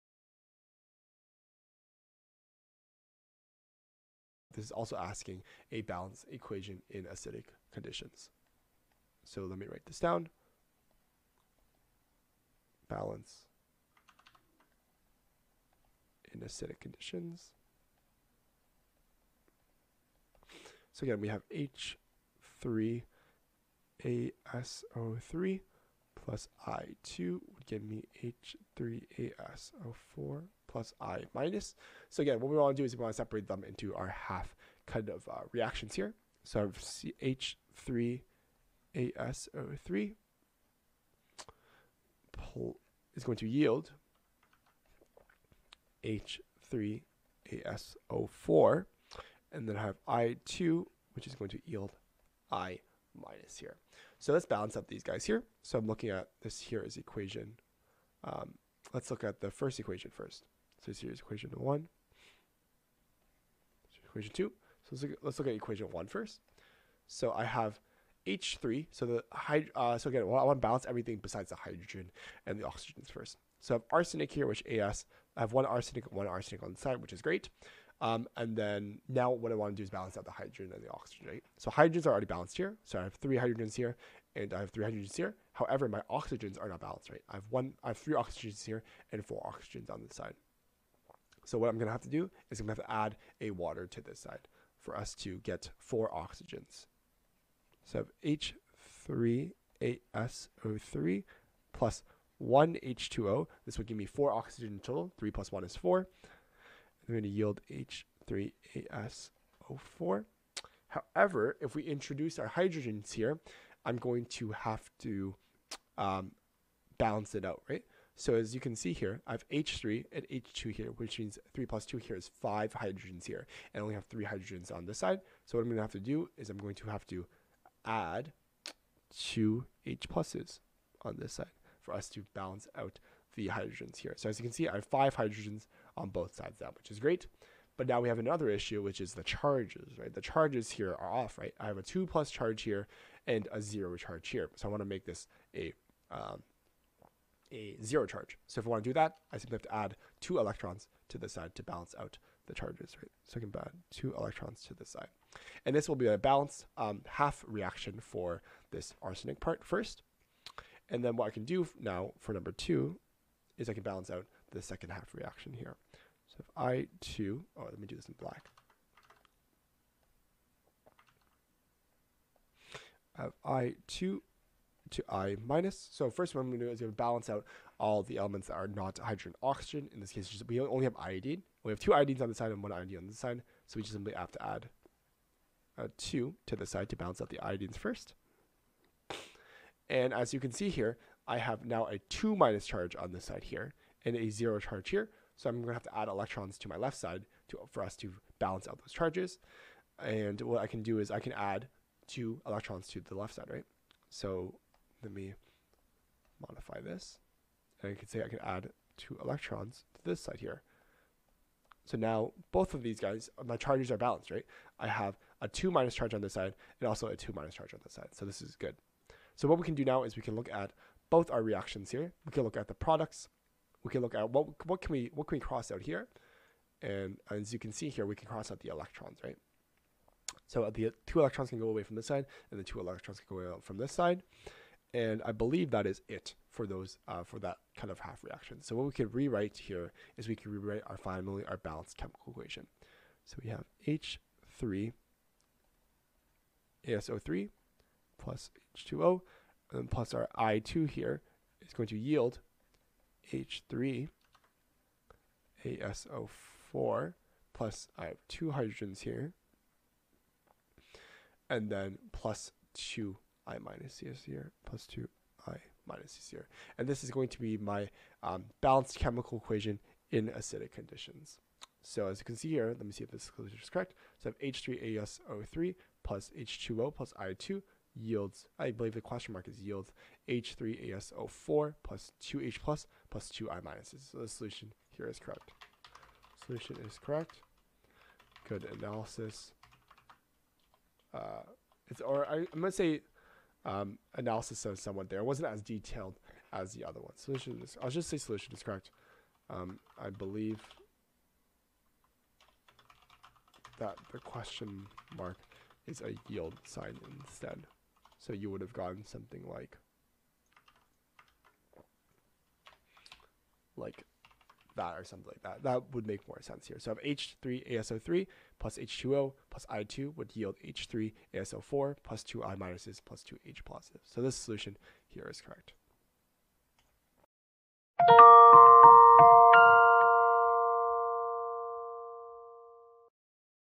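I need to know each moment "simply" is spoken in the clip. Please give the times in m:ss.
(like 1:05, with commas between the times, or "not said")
2:29, 3:03.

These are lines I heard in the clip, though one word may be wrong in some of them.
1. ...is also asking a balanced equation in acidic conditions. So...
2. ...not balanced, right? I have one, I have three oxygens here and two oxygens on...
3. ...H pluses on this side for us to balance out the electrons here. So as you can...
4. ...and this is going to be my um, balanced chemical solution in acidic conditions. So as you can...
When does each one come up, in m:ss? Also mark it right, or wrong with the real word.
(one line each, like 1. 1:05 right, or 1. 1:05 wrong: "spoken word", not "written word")
1. 0:04 right
2. 1:26 wrong: "four", not "two"
3. 2:09 wrong: "hydrogens", not "electrons"
4. 4:26 wrong: "equation", not "solution".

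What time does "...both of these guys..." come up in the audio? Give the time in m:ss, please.
3:32.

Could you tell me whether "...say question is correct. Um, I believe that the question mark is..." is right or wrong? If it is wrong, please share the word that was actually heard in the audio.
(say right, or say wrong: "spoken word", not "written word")
wrong: "solution", not "question".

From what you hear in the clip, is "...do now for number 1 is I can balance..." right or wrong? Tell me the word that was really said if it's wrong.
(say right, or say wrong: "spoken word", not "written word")
wrong: "2", not "1".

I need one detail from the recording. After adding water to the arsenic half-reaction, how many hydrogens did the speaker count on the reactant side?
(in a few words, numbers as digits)
5.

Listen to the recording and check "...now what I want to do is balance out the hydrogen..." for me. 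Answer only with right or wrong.
right.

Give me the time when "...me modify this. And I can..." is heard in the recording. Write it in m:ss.
3:25.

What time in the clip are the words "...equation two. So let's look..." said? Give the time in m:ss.
1:04.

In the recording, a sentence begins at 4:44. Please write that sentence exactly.
So the solution here is correct.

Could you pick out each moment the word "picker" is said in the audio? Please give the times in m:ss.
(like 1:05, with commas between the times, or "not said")
not said.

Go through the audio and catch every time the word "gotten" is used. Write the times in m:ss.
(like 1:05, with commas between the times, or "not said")
5:08.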